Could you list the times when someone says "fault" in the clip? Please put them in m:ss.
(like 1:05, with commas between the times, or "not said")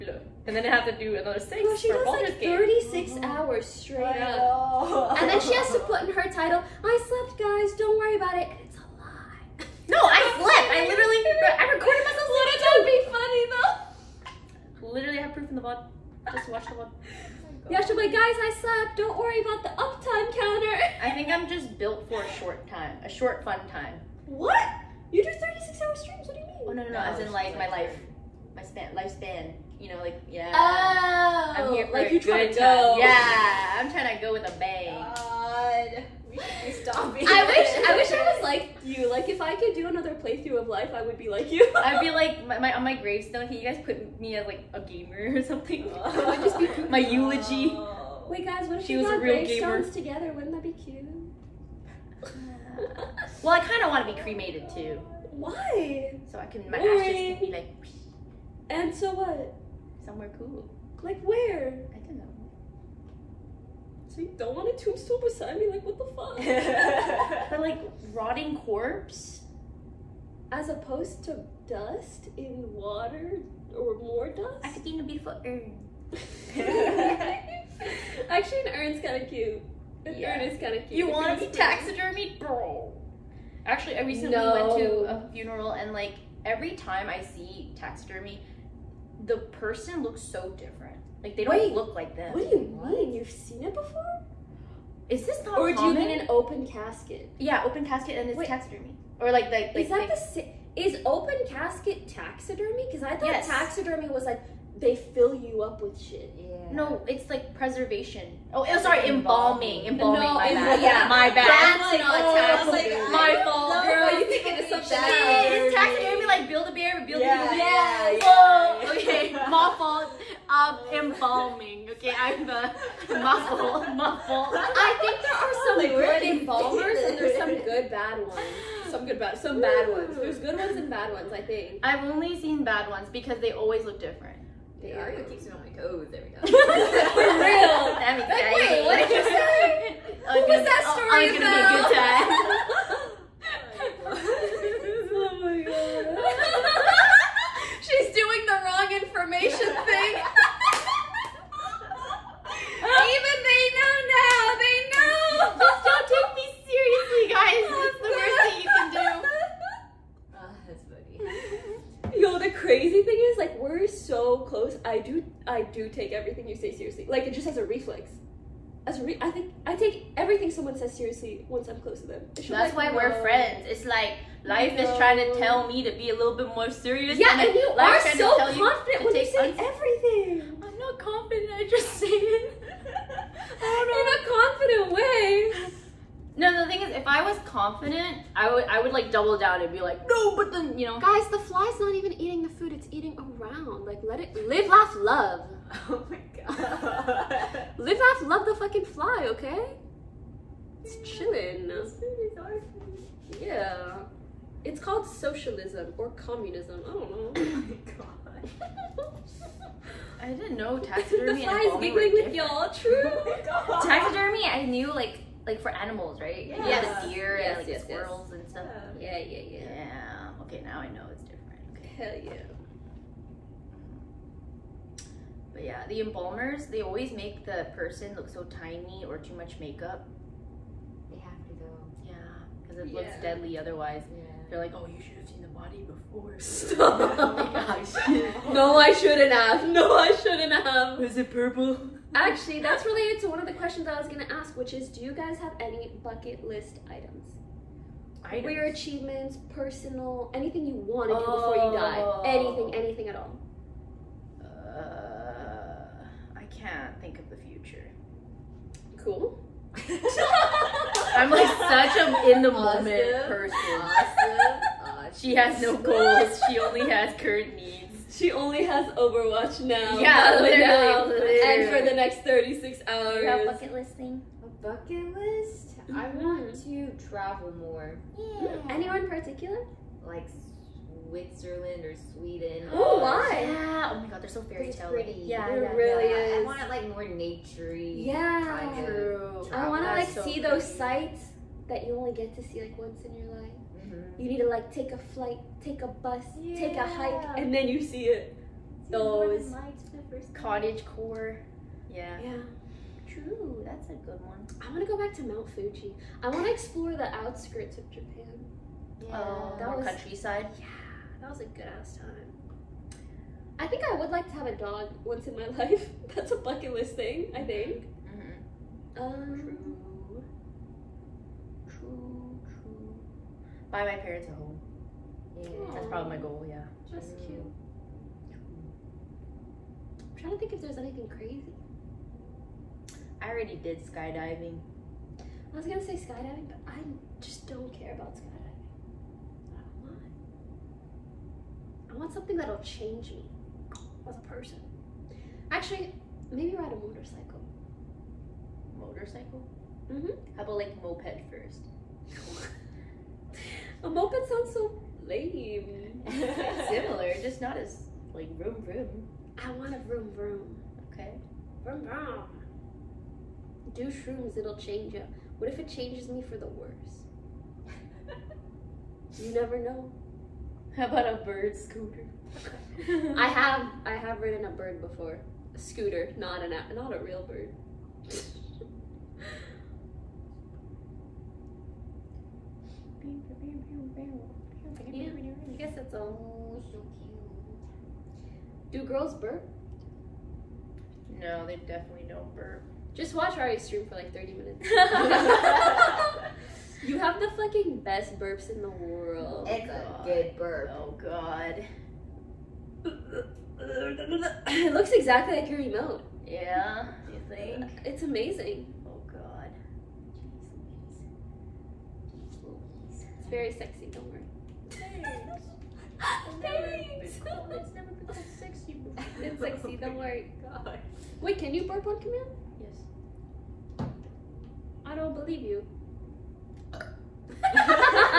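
1:53, 1:59.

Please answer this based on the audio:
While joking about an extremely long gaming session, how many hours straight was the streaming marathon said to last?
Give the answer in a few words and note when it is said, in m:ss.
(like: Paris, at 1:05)
36, at 0:02.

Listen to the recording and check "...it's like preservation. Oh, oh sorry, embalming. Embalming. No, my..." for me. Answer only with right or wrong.
right.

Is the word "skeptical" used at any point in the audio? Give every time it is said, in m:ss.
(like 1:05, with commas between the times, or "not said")
not said.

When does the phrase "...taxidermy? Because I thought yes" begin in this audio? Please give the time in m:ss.
1:42.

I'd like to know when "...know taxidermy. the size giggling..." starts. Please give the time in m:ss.
3:30.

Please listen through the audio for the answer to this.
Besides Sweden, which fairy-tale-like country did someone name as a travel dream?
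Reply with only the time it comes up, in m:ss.
4:41.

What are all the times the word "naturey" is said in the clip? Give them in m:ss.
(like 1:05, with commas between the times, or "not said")
4:47.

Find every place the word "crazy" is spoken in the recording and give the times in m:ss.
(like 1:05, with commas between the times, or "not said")
2:42, 5:31.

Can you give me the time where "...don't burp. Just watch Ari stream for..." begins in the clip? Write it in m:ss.
6:32.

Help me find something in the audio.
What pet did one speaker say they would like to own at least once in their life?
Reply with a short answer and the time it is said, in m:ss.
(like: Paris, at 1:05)
A dog, at 5:14.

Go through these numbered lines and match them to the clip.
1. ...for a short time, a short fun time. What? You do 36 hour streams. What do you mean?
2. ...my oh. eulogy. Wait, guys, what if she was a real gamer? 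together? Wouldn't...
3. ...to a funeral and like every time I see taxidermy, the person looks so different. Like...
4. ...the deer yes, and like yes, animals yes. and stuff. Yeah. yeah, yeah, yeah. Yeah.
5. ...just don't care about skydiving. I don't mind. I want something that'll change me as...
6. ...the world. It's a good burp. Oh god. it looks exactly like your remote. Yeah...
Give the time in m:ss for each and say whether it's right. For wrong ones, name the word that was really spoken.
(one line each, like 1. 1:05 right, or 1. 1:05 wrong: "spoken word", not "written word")
1. 0:22 right
2. 0:46 right
3. 1:24 right
4. 3:37 wrong: "squirrels", not "animals"
5. 5:37 right
6. 6:38 right.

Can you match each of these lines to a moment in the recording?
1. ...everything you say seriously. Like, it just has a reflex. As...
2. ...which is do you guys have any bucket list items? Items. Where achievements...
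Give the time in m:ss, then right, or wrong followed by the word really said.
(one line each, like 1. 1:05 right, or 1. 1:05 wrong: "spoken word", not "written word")
1. 2:46 right
2. 4:04 right.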